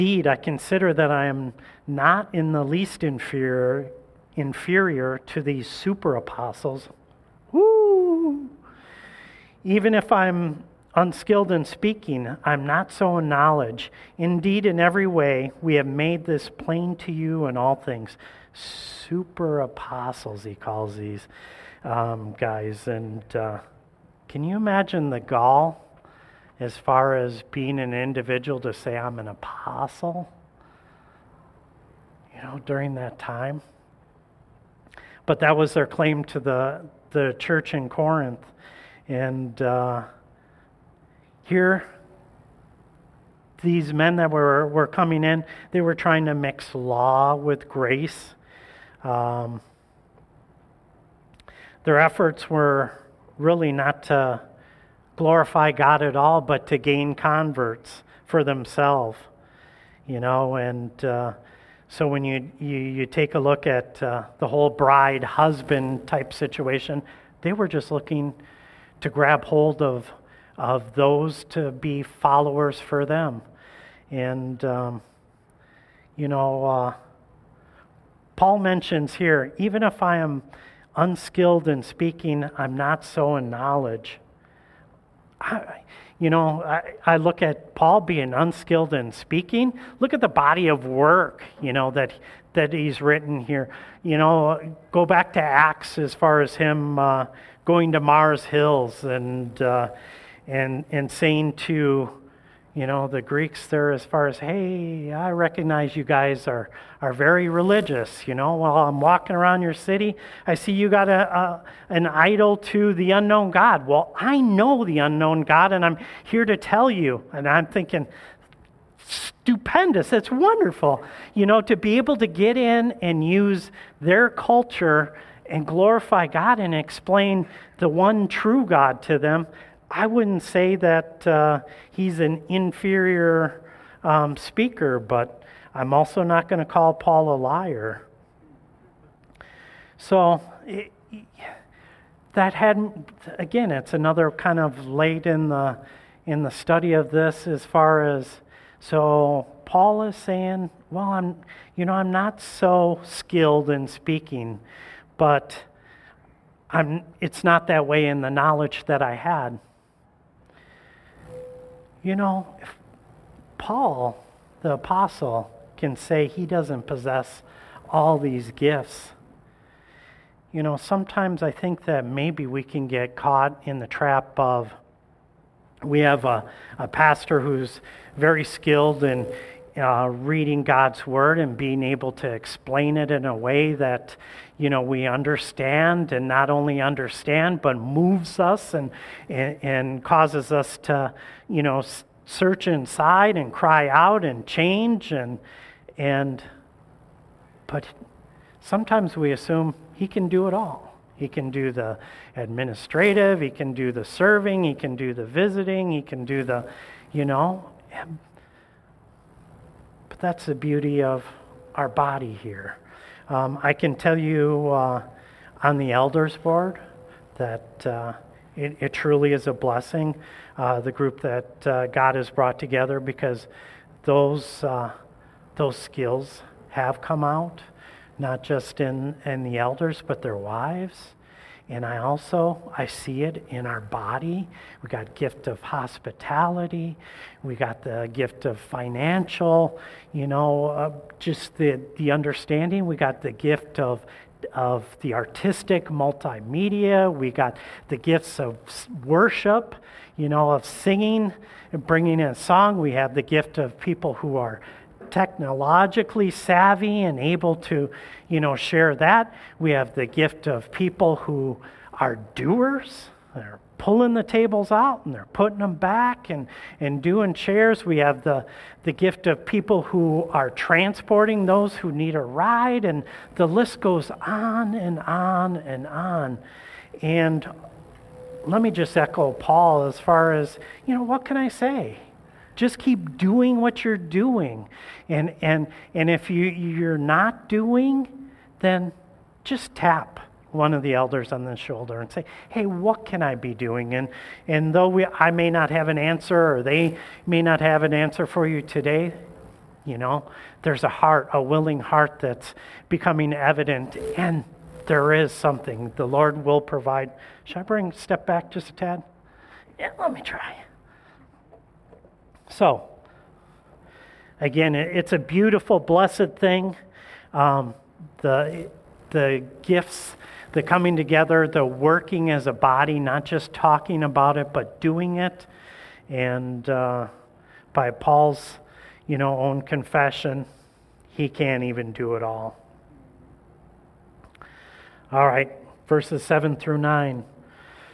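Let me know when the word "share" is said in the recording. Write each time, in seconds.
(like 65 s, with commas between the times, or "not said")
258 s.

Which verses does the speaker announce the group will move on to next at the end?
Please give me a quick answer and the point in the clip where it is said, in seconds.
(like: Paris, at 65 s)
7 through 9, at 335 s.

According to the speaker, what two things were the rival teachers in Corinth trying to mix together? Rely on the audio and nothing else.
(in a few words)
law with grace.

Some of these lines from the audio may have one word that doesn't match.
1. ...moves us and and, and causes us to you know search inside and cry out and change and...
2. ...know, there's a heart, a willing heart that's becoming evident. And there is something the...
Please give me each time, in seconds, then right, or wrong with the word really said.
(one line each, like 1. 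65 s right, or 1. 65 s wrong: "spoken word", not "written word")
1. 187 s right
2. 299 s right.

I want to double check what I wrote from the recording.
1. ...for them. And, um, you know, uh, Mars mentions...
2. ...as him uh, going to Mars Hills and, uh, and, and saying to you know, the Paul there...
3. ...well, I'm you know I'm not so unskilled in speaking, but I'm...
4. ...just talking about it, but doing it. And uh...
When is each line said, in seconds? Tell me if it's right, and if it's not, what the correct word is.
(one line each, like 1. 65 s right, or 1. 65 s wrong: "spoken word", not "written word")
1. 72 s wrong: "Paul", not "Mars"
2. 96 s wrong: "Greeks", not "Paul"
3. 150 s wrong: "skilled", not "unskilled"
4. 323 s right.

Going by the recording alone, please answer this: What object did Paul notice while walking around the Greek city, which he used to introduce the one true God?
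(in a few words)
idol to the unknown God.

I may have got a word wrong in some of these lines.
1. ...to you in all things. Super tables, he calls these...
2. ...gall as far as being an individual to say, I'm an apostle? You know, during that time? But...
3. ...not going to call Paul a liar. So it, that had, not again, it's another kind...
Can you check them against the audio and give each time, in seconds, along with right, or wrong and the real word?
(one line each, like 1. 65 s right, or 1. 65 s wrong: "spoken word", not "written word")
1. 16 s wrong: "apostles", not "tables"
2. 25 s right
3. 136 s right.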